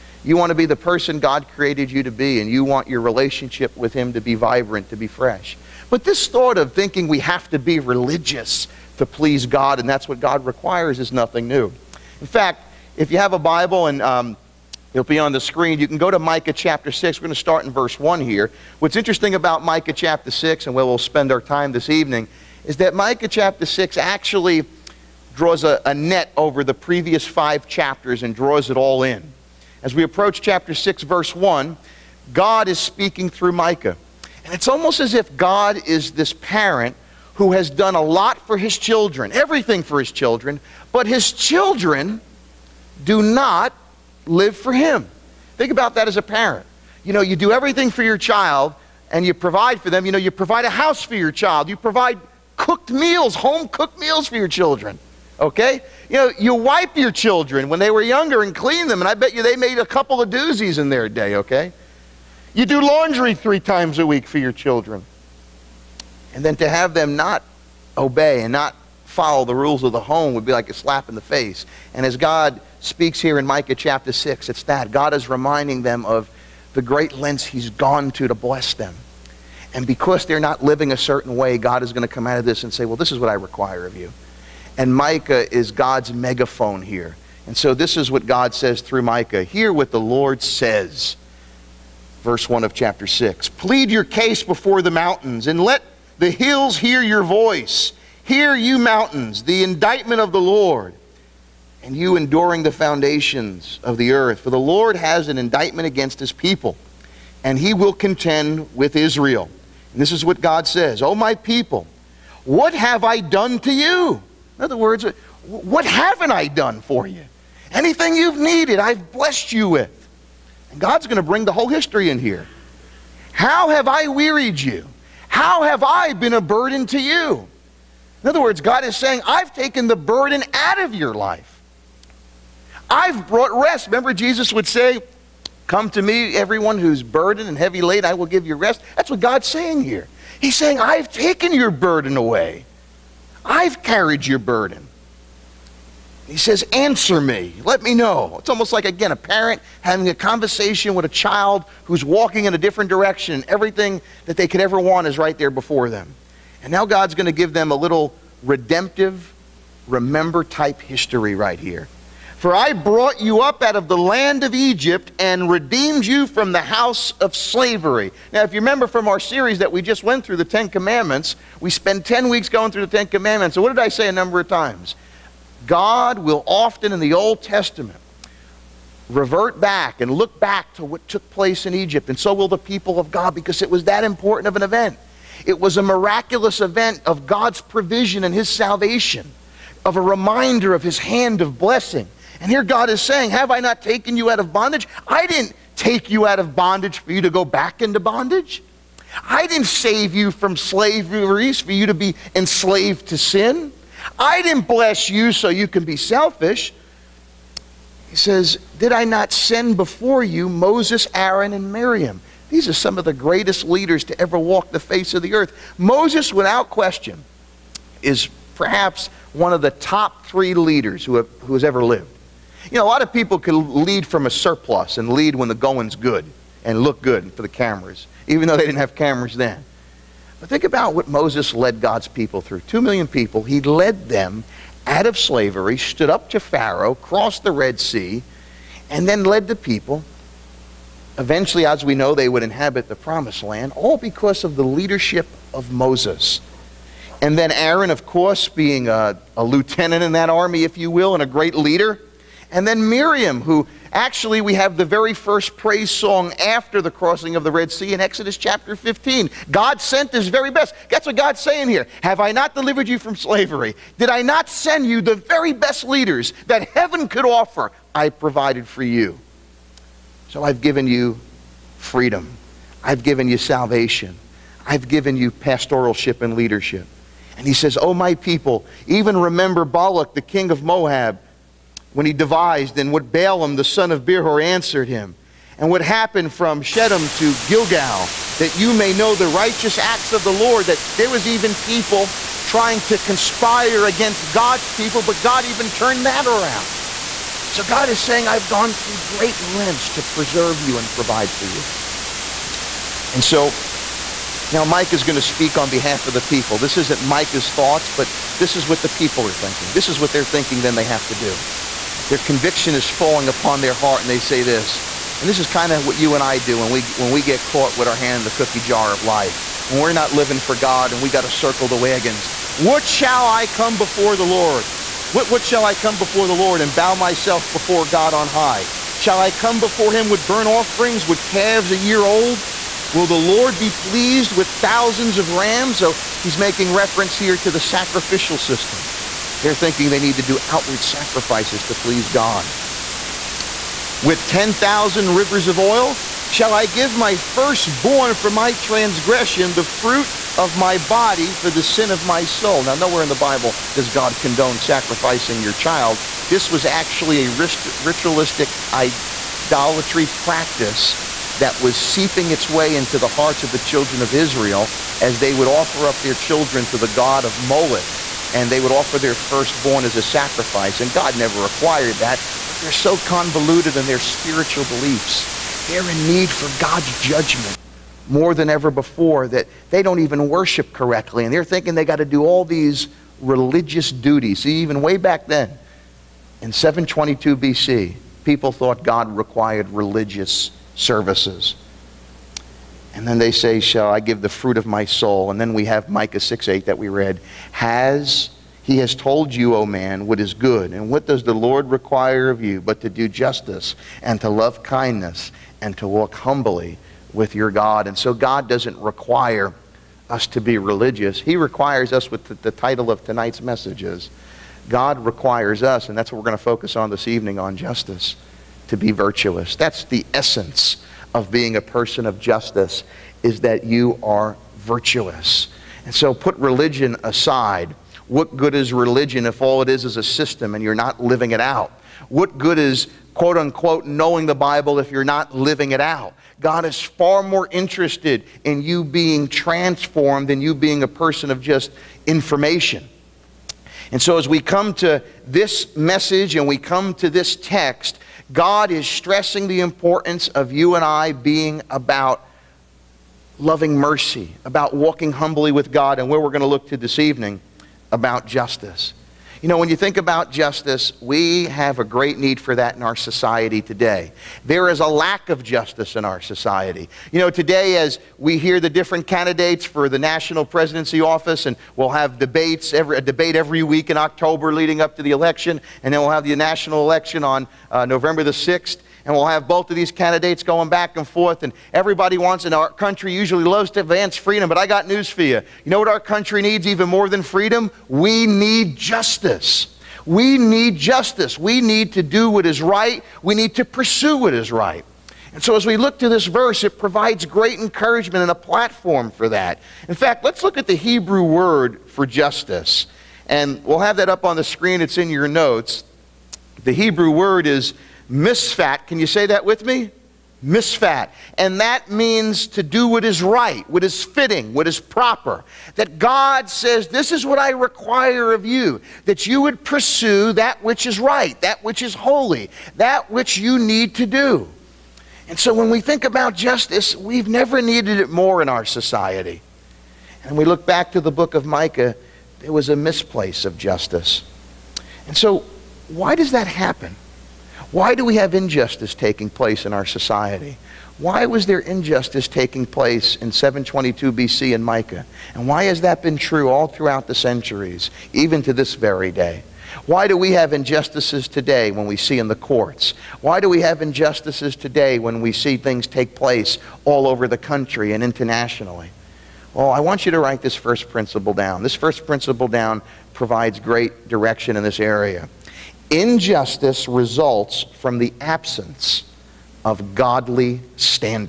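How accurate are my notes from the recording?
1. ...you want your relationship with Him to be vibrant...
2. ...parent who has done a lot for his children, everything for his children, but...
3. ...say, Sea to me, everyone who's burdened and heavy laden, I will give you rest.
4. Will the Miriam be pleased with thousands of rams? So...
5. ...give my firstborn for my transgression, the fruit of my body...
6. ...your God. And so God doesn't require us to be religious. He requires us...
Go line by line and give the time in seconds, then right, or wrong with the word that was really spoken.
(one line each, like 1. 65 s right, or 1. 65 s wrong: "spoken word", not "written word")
1. 2 s right
2. 36 s right
3. 134 s wrong: "Come", not "Sea"
4. 332 s wrong: "Lord", not "Miriam"
5. 346 s right
6. 407 s right.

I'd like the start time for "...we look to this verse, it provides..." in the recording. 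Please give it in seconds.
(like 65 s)
495 s.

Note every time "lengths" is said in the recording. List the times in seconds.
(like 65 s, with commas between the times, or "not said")
77 s, 299 s.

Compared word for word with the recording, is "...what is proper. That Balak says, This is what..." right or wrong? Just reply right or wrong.
wrong.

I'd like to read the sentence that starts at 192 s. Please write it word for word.
And here God is saying, Have I not taken you out of bondage?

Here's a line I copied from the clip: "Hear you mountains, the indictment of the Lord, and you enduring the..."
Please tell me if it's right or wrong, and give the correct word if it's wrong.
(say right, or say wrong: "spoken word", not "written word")
right.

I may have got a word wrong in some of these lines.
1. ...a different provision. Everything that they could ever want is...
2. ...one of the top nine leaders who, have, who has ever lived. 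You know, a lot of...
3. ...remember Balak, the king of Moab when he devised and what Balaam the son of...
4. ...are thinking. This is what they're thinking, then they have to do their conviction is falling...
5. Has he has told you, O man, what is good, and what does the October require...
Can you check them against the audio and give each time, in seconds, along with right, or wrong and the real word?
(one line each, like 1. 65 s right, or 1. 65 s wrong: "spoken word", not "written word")
1. 152 s wrong: "direction", not "provision"
2. 219 s wrong: "three", not "nine"
3. 279 s right
4. 309 s right
5. 397 s wrong: "Lord", not "October".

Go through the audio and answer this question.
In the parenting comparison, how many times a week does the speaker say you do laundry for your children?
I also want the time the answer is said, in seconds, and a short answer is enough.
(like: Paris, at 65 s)
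3, at 63 s.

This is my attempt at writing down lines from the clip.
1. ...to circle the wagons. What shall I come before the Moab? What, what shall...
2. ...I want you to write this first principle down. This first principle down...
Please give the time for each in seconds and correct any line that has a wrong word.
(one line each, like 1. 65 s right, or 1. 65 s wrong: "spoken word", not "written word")
1. 321 s wrong: "Lord", not "Moab"
2. 559 s right.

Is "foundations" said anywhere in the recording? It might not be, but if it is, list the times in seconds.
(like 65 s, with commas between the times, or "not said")
102 s.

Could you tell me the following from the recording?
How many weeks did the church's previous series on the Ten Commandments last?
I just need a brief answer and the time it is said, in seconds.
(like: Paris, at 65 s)
10, at 172 s.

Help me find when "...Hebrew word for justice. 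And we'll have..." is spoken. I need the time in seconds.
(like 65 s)
500 s.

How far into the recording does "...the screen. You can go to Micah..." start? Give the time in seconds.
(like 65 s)
15 s.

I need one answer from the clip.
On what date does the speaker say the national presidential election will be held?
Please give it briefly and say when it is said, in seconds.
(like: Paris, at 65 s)
November 6, at 477 s.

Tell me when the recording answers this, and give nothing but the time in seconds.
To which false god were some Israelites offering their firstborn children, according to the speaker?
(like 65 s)
367 s.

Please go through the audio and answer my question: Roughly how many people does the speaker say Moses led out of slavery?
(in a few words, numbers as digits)
2 million.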